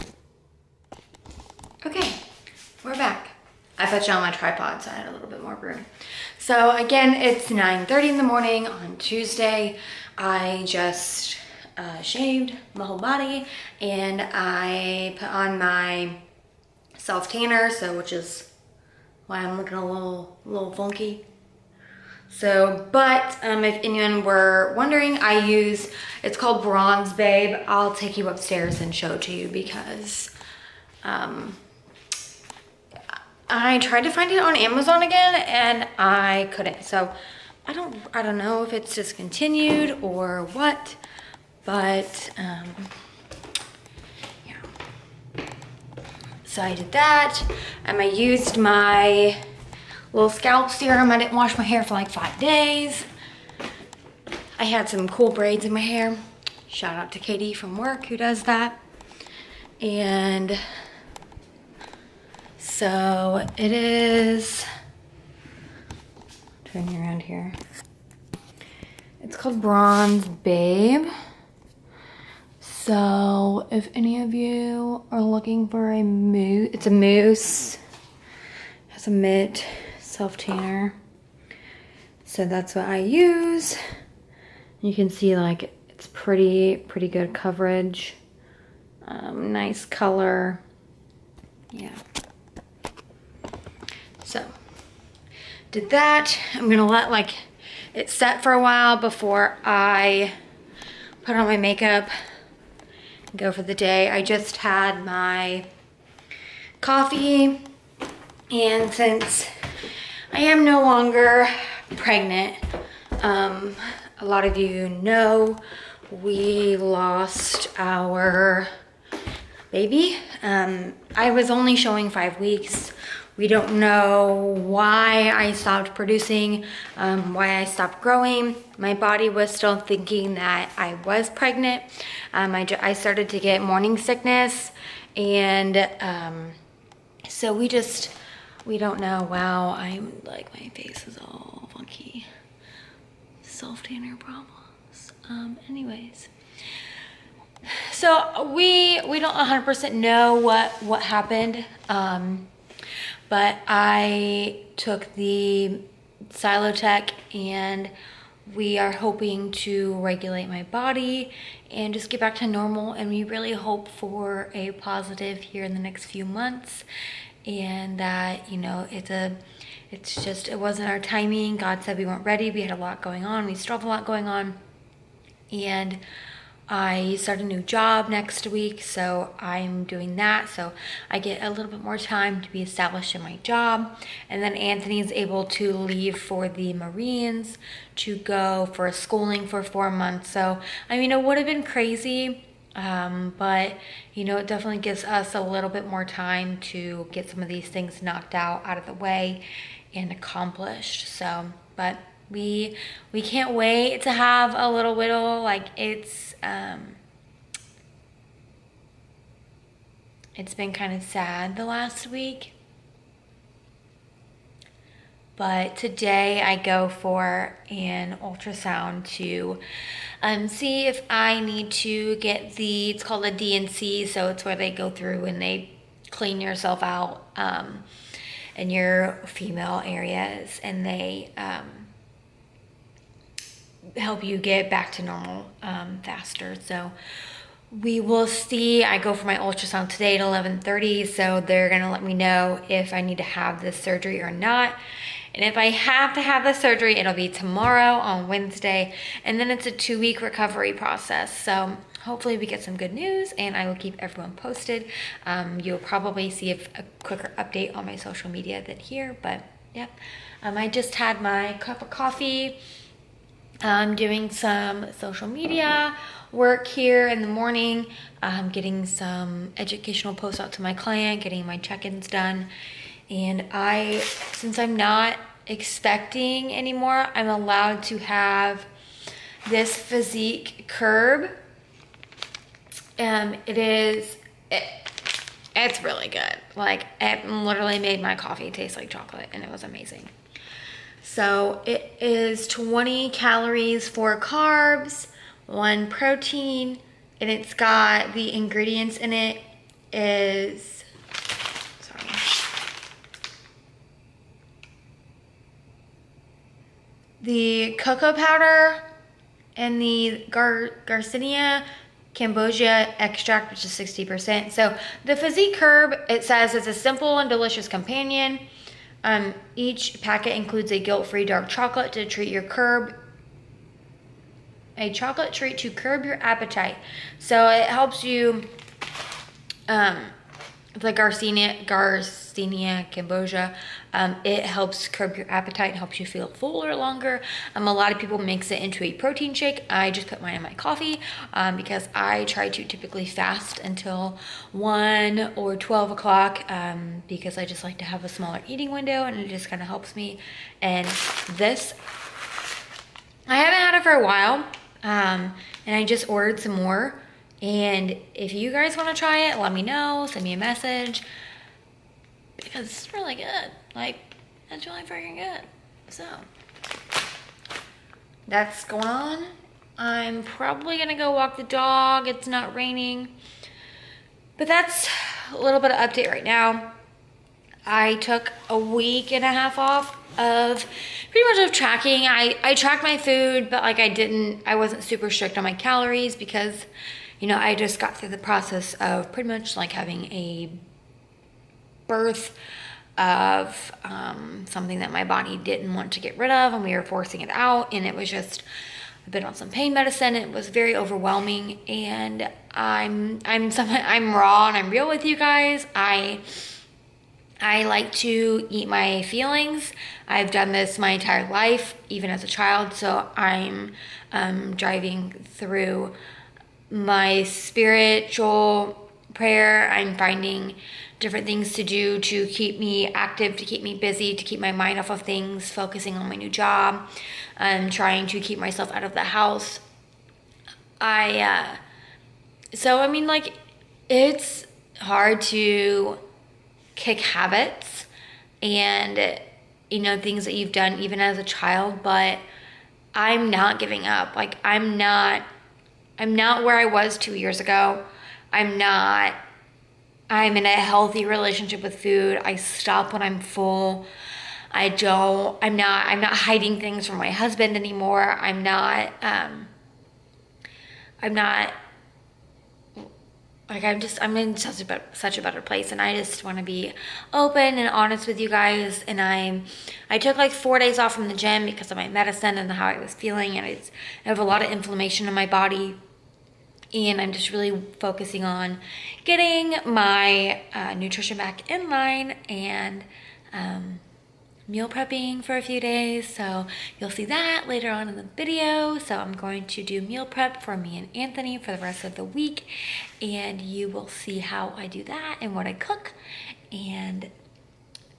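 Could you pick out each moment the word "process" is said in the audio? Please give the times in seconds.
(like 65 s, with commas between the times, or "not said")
250 s, 388 s.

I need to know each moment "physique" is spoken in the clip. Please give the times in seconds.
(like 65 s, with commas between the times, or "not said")
279 s, 315 s.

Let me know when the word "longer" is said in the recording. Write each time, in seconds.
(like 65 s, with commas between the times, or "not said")
110 s, 336 s.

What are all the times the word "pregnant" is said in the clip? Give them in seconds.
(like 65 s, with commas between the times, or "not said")
111 s, 131 s.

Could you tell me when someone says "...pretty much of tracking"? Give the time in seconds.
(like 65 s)
381 s.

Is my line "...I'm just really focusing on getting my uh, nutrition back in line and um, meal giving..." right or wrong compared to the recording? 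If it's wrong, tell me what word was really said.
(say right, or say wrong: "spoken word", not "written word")
wrong: "prepping", not "giving".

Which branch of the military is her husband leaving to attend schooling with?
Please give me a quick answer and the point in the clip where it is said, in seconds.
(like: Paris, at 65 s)
Marines, at 186 s.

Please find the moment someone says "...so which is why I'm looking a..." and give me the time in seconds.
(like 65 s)
17 s.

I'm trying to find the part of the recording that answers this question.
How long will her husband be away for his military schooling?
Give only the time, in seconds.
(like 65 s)
189 s.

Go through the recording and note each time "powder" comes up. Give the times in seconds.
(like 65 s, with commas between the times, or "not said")
308 s.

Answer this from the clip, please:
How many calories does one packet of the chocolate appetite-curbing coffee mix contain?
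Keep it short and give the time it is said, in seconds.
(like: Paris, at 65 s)
20, at 292 s.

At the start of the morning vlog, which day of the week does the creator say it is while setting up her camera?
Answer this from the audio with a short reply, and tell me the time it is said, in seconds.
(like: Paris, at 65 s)
Tuesday, at 8 s.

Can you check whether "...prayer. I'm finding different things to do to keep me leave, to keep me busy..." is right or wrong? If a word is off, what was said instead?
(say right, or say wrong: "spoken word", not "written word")
wrong: "active", not "leave".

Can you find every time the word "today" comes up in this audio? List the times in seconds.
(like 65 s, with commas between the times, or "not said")
215 s, 239 s.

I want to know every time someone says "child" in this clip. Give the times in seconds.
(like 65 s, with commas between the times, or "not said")
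412 s, 441 s.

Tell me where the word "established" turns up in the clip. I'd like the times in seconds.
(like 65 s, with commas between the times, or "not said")
182 s.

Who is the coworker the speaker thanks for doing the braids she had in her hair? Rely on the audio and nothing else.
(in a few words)
Katie.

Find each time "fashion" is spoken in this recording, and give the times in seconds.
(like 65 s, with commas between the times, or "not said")
not said.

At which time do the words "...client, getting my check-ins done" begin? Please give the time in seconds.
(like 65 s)
270 s.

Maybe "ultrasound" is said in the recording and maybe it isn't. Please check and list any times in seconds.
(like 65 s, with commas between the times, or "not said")
218 s, 239 s.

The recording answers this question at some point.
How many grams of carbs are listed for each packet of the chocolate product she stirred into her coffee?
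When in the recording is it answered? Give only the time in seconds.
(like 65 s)
293 s.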